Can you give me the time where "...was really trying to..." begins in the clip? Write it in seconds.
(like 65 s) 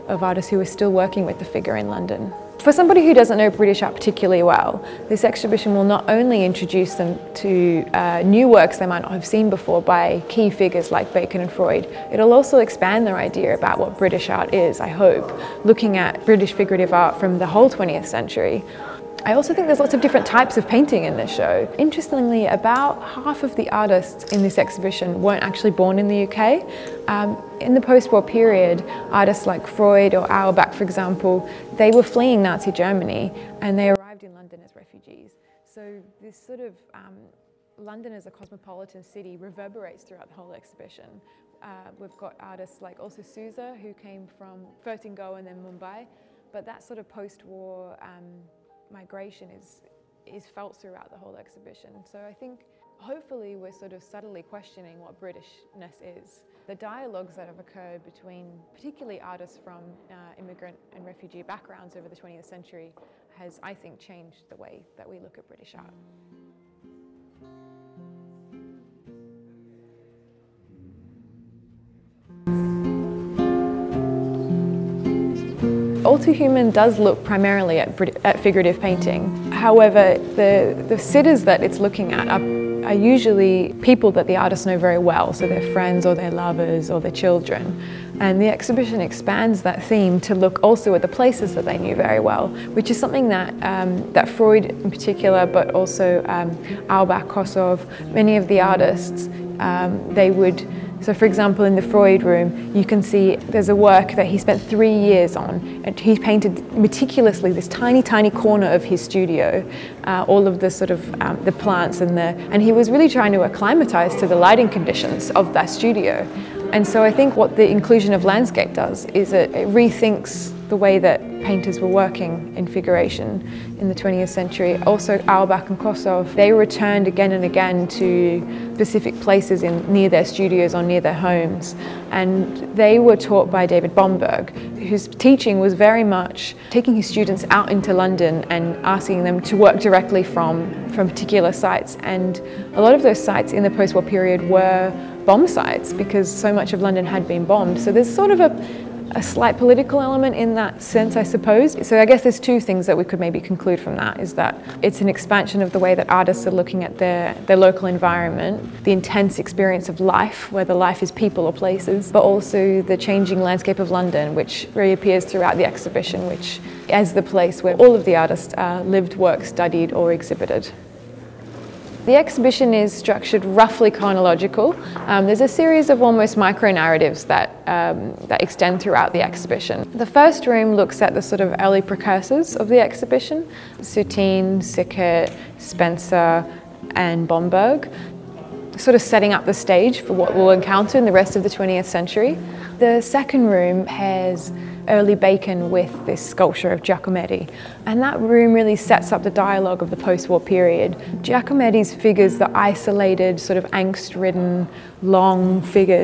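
112 s.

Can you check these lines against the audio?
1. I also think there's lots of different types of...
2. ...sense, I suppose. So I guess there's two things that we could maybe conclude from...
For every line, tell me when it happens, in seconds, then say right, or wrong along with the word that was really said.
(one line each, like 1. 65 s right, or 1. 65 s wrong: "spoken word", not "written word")
1. 19 s right
2. 150 s right.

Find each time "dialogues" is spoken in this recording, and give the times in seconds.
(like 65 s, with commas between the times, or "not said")
56 s, 199 s.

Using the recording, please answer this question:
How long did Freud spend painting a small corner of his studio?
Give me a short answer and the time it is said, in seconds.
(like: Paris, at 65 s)
3 years, at 104 s.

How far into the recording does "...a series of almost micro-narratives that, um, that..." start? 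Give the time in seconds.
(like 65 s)
175 s.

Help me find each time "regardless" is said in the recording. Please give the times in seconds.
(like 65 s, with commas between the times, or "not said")
not said.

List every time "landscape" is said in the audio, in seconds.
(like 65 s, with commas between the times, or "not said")
118 s, 163 s.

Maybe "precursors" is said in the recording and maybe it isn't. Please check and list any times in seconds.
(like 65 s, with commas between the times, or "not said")
181 s.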